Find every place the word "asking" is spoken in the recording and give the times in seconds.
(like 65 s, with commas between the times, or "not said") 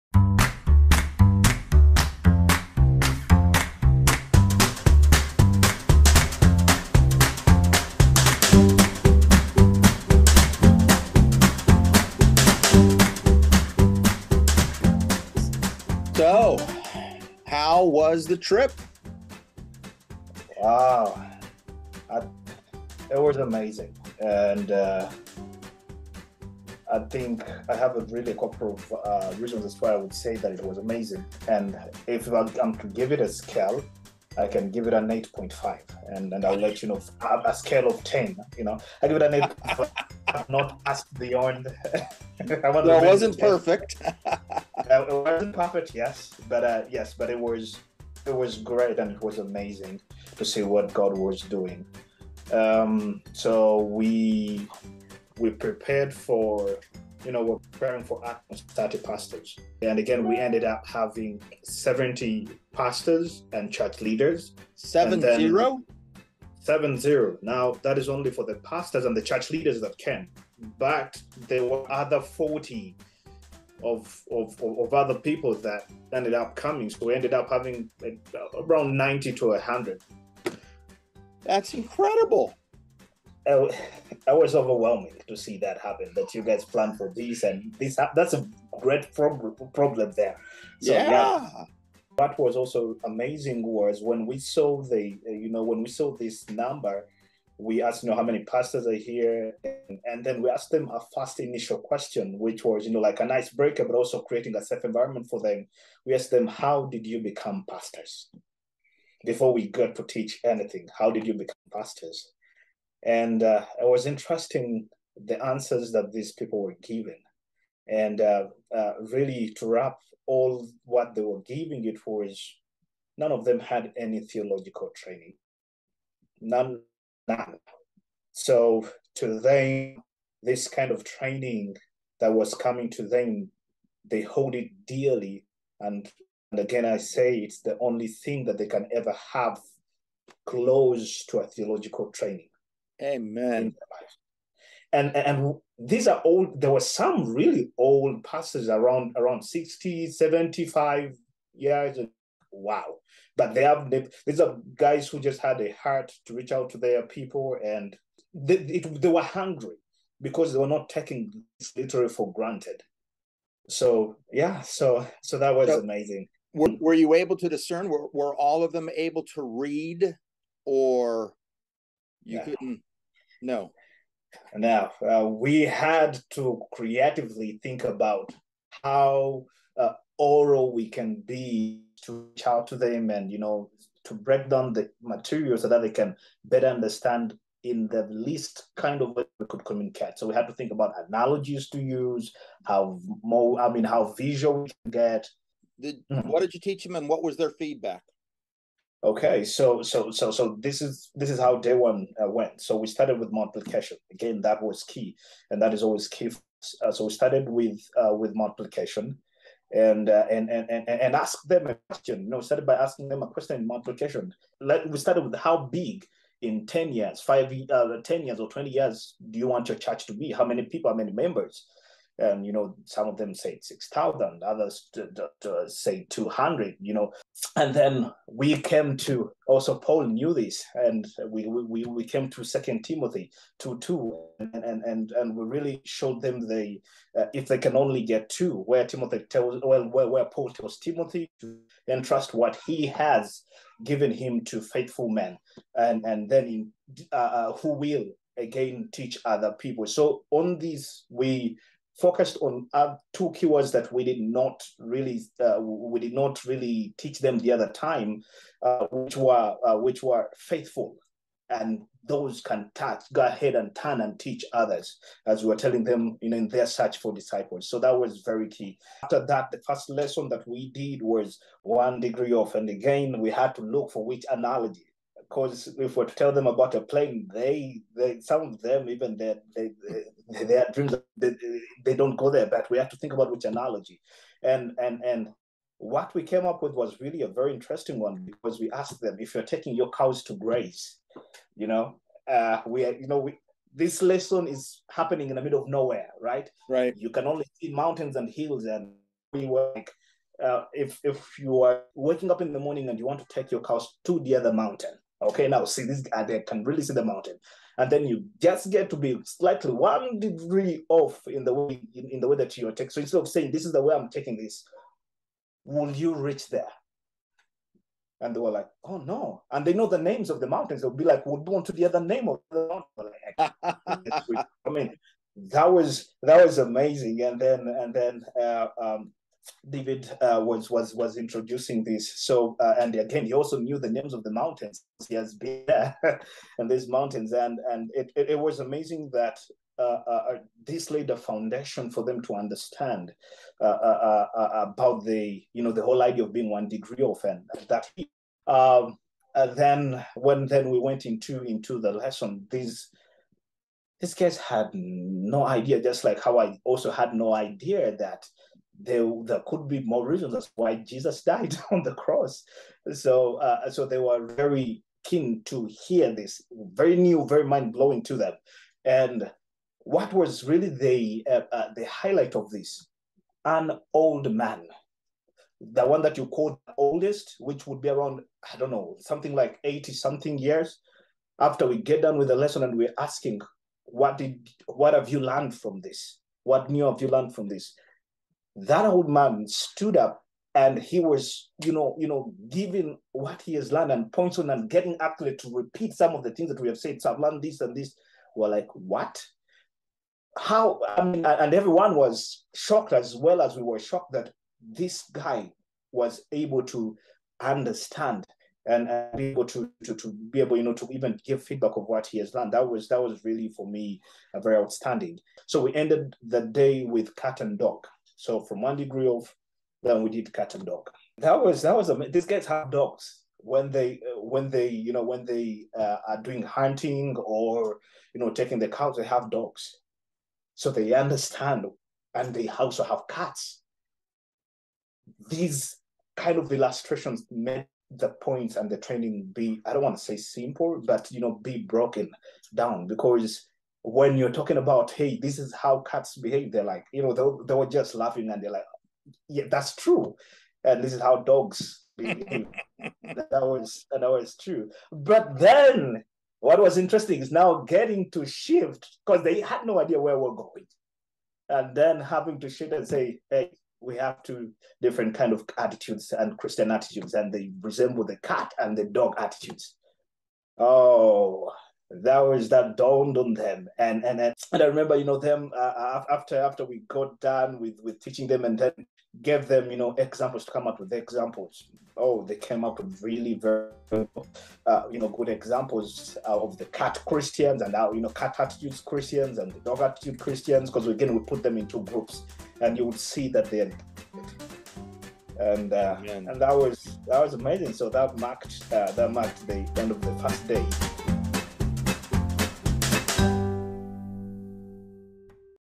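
212 s, 382 s.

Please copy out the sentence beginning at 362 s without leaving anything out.
So, uh, so they were very keen to hear this, very new, very mind blowing to them.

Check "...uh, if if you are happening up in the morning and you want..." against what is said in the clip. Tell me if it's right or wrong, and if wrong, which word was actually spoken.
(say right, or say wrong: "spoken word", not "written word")
wrong: "waking", not "happening".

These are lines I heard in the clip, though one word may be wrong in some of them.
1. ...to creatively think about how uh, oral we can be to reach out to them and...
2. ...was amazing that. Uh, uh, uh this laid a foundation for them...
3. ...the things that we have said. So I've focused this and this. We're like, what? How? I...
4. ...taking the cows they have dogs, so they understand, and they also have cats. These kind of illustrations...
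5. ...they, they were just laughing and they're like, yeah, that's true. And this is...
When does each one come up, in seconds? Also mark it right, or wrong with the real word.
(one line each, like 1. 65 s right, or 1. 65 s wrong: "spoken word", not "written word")
1. 176 s right
2. 338 s right
3. 396 s wrong: "learned", not "focused"
4. 428 s right
5. 447 s right.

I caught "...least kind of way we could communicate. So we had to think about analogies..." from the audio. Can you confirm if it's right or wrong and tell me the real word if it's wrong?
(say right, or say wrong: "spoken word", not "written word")
right.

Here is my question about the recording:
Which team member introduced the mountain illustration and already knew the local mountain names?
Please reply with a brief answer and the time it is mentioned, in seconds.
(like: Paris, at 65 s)
David, at 329 s.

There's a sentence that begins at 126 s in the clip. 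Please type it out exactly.
None now, So to them, this kind of training that was coming to them, they hold it dearly.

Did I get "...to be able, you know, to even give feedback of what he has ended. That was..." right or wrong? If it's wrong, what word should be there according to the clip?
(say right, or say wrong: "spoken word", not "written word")
wrong: "learned", not "ended".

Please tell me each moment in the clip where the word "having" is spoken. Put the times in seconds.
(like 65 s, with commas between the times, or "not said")
60 s, 77 s, 461 s.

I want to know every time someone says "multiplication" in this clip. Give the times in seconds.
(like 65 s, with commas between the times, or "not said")
203 s, 208 s, 213 s.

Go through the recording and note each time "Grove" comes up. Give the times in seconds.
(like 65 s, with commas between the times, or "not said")
418 s.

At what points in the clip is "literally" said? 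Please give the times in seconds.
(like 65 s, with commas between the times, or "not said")
161 s.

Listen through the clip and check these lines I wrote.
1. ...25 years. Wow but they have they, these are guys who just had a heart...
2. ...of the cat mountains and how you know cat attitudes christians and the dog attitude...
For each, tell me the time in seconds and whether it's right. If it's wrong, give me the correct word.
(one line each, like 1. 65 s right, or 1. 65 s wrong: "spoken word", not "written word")
1. 150 s wrong: "75", not "25"
2. 486 s wrong: "christians", not "mountains".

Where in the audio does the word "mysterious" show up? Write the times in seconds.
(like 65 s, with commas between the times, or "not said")
not said.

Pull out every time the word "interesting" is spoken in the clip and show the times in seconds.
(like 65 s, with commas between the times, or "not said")
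114 s, 287 s, 456 s.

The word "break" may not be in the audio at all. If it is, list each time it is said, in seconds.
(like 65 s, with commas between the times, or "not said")
103 s, 184 s.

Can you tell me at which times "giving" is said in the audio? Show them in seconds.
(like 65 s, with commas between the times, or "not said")
121 s, 392 s.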